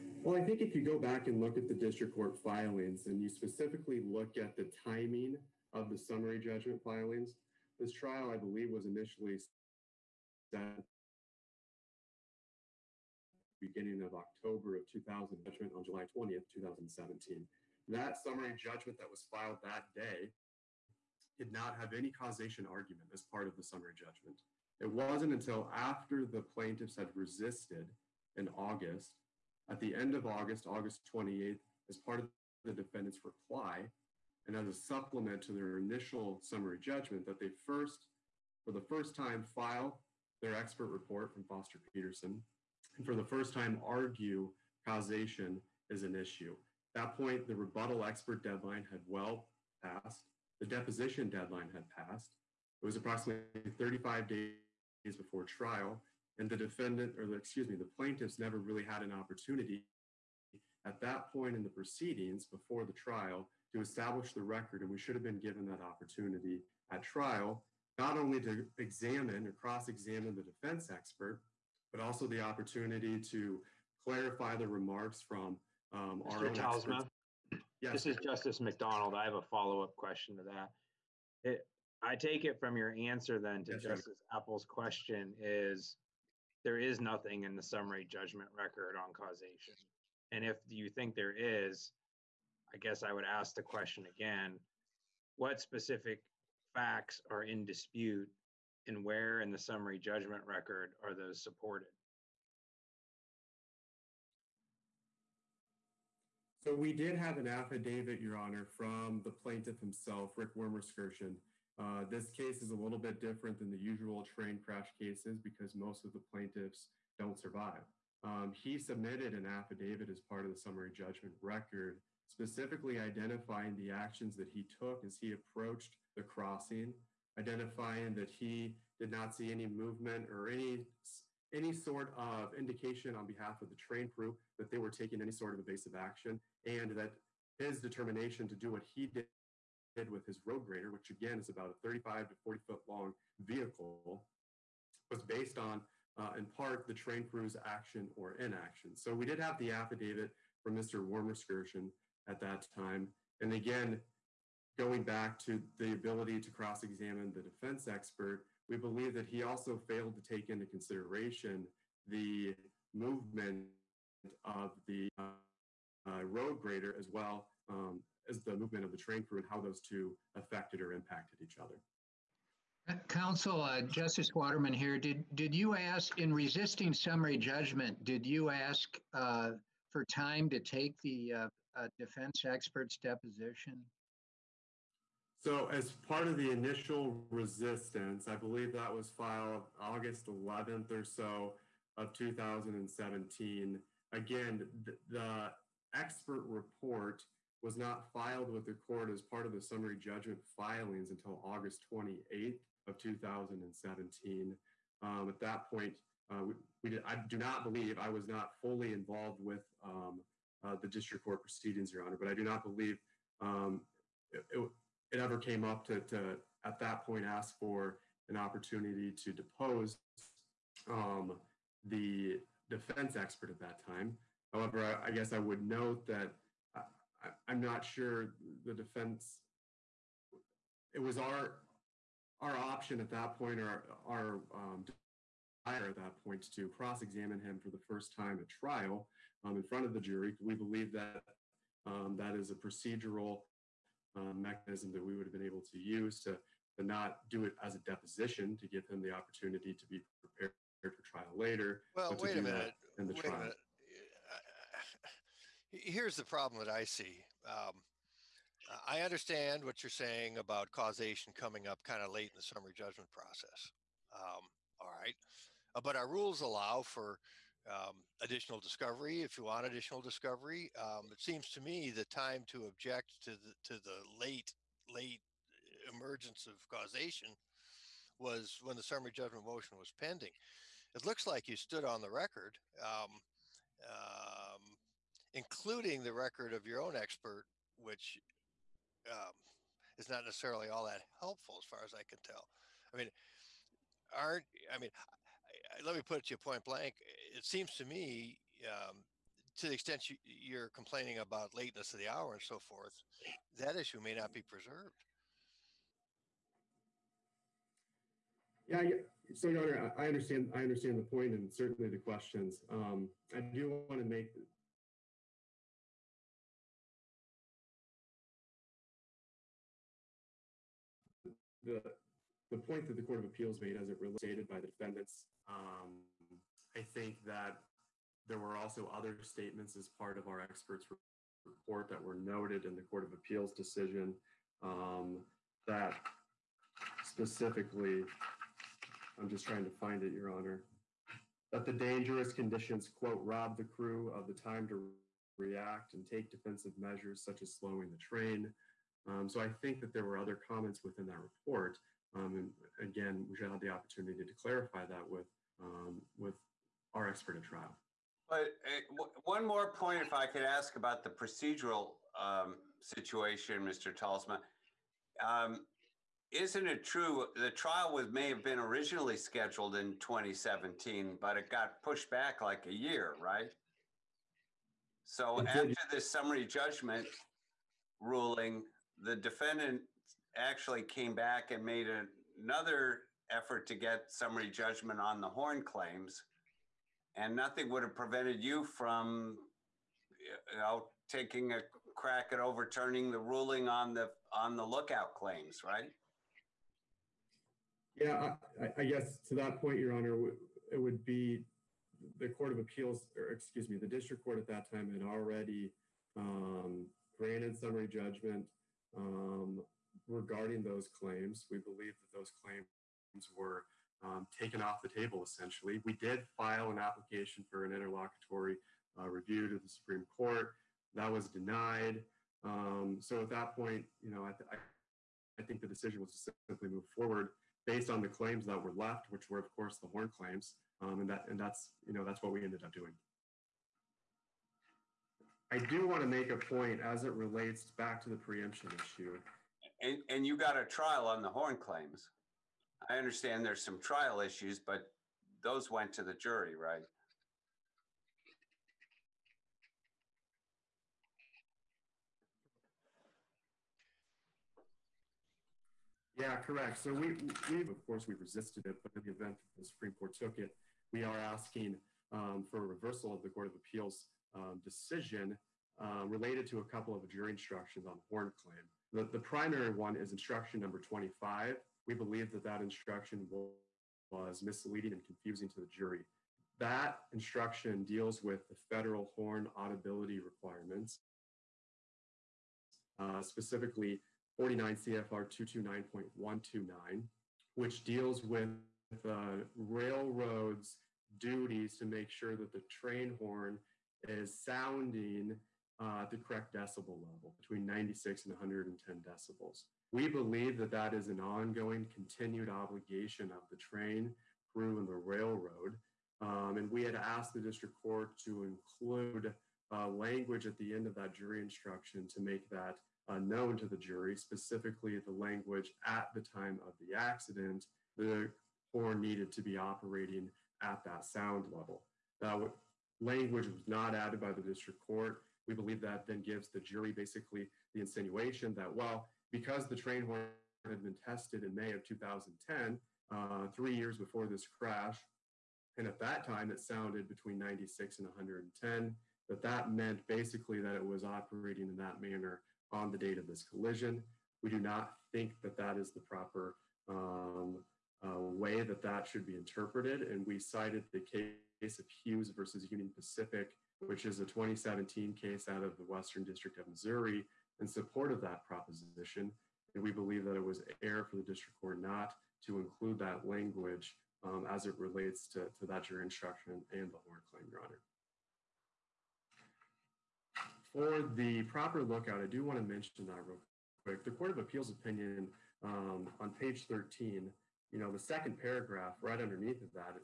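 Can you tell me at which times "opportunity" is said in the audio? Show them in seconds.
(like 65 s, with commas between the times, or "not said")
59 s, 65 s, 72 s, 218 s, 249 s, 353 s.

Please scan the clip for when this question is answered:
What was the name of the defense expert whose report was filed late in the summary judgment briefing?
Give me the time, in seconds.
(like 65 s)
41 s.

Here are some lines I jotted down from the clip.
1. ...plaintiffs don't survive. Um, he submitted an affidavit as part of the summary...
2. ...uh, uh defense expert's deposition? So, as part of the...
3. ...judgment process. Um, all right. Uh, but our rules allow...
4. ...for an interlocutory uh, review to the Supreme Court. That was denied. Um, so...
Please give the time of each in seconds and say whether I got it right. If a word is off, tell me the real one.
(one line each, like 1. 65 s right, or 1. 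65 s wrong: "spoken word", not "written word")
1. 116 s right
2. 181 s right
3. 262 s right
4. 417 s right.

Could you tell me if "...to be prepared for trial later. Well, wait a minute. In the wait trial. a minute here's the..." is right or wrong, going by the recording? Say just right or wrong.
right.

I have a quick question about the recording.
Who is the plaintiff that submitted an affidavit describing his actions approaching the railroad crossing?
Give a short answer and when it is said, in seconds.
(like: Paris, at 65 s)
Rick Wermerskirchen, at 110 s.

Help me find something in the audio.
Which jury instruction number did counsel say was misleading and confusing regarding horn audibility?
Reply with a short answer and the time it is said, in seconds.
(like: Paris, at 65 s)
25, at 470 s.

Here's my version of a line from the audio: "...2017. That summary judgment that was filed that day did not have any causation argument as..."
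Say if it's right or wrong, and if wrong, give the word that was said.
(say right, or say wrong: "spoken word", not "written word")
right.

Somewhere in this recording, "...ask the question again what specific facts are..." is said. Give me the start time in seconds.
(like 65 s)
93 s.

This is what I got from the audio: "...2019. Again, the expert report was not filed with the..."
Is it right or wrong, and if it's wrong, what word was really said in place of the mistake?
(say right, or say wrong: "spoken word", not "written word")
wrong: "2017", not "2019".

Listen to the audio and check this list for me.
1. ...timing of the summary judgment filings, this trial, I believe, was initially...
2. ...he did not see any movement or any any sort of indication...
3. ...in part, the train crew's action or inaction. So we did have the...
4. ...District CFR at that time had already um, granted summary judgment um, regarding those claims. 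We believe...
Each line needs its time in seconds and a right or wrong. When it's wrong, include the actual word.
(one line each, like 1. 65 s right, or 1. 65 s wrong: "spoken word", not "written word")
1. 4 s right
2. 128 s right
3. 146 s right
4. 403 s wrong: "Court", not "CFR".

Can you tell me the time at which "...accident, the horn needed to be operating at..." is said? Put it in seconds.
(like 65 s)
516 s.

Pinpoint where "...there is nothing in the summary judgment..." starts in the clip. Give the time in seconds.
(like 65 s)
86 s.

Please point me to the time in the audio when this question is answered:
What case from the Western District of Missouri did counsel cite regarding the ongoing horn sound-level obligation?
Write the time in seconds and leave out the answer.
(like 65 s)
551 s.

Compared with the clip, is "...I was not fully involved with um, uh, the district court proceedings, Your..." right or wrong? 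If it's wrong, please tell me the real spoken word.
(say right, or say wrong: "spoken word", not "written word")
right.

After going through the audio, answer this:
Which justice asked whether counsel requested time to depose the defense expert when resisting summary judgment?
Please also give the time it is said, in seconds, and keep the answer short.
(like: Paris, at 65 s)
Justice Waterman, at 173 s.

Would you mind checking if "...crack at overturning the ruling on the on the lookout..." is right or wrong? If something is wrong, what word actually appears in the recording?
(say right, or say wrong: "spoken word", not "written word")
right.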